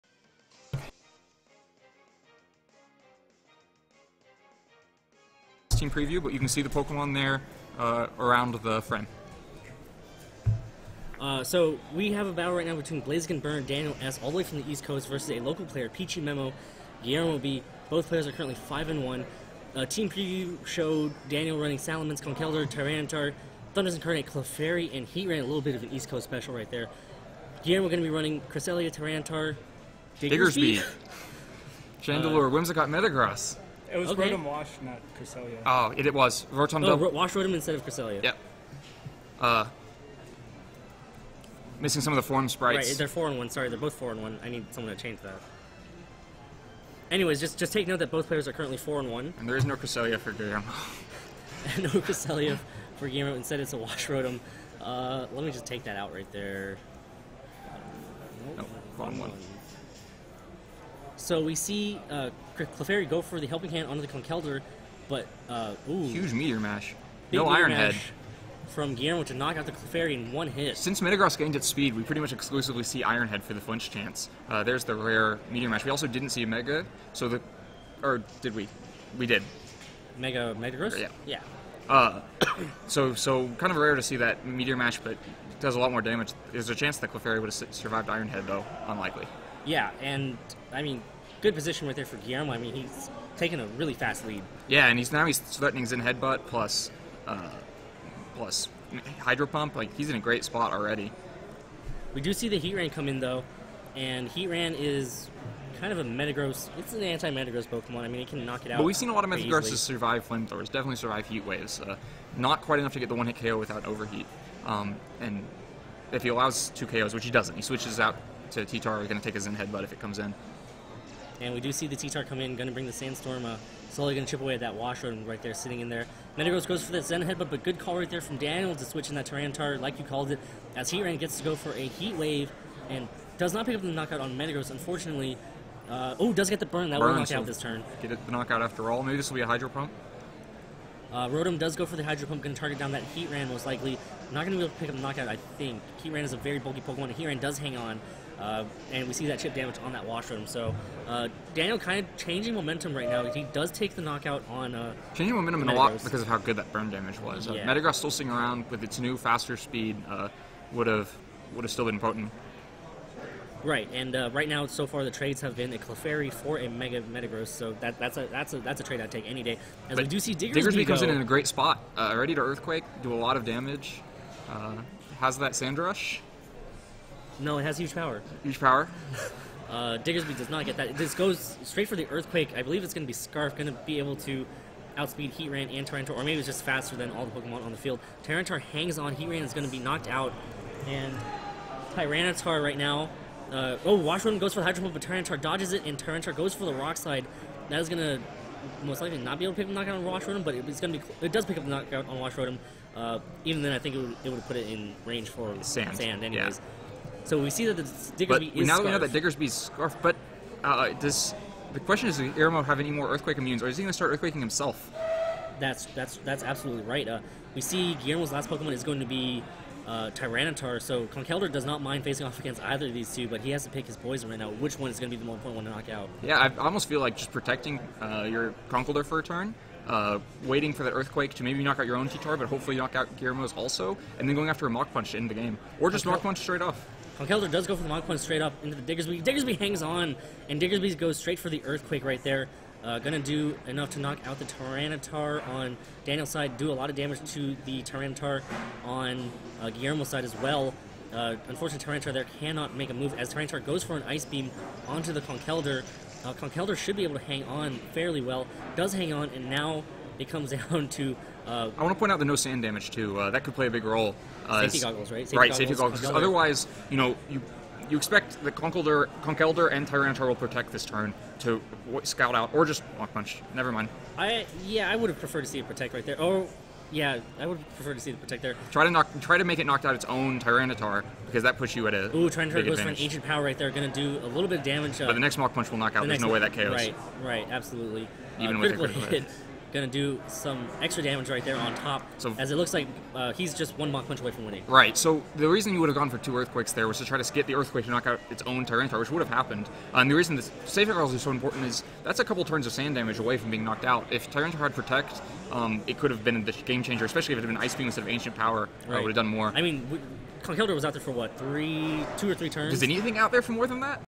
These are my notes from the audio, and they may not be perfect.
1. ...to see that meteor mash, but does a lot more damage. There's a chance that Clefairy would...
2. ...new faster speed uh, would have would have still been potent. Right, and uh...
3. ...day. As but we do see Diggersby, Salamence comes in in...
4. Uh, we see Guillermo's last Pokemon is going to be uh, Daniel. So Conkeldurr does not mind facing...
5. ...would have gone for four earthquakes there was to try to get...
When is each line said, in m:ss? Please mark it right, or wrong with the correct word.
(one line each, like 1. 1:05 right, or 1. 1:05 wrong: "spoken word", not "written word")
1. 1:23 right
2. 2:38 right
3. 2:49 wrong: "Diggersby", not "Salamence"
4. 3:37 wrong: "Tyranitar", not "Daniel"
5. 4:55 wrong: "two", not "four".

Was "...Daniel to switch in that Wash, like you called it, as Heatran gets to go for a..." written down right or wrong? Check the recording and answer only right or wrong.
wrong.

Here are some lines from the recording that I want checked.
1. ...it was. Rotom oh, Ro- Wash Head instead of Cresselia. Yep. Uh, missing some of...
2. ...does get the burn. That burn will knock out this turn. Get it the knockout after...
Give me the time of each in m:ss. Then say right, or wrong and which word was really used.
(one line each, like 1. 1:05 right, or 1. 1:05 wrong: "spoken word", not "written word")
1. 0:36 wrong: "Rotom", not "Head"
2. 2:16 right.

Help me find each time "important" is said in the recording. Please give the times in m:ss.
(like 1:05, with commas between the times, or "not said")
3:45, 5:01.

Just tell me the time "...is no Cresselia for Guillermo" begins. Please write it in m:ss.
0:49.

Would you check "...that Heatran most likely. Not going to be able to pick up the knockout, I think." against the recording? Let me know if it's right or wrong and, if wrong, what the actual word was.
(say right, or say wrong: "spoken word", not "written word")
right.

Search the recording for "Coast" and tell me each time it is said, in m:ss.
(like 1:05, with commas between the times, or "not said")
0:14, 0:26.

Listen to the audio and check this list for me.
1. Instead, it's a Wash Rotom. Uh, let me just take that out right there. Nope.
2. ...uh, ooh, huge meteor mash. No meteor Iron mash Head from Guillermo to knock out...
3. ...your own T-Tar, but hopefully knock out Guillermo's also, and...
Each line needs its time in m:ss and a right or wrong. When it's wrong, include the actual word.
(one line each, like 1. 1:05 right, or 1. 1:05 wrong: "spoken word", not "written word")
1. 0:53 right
2. 1:05 right
3. 3:51 right.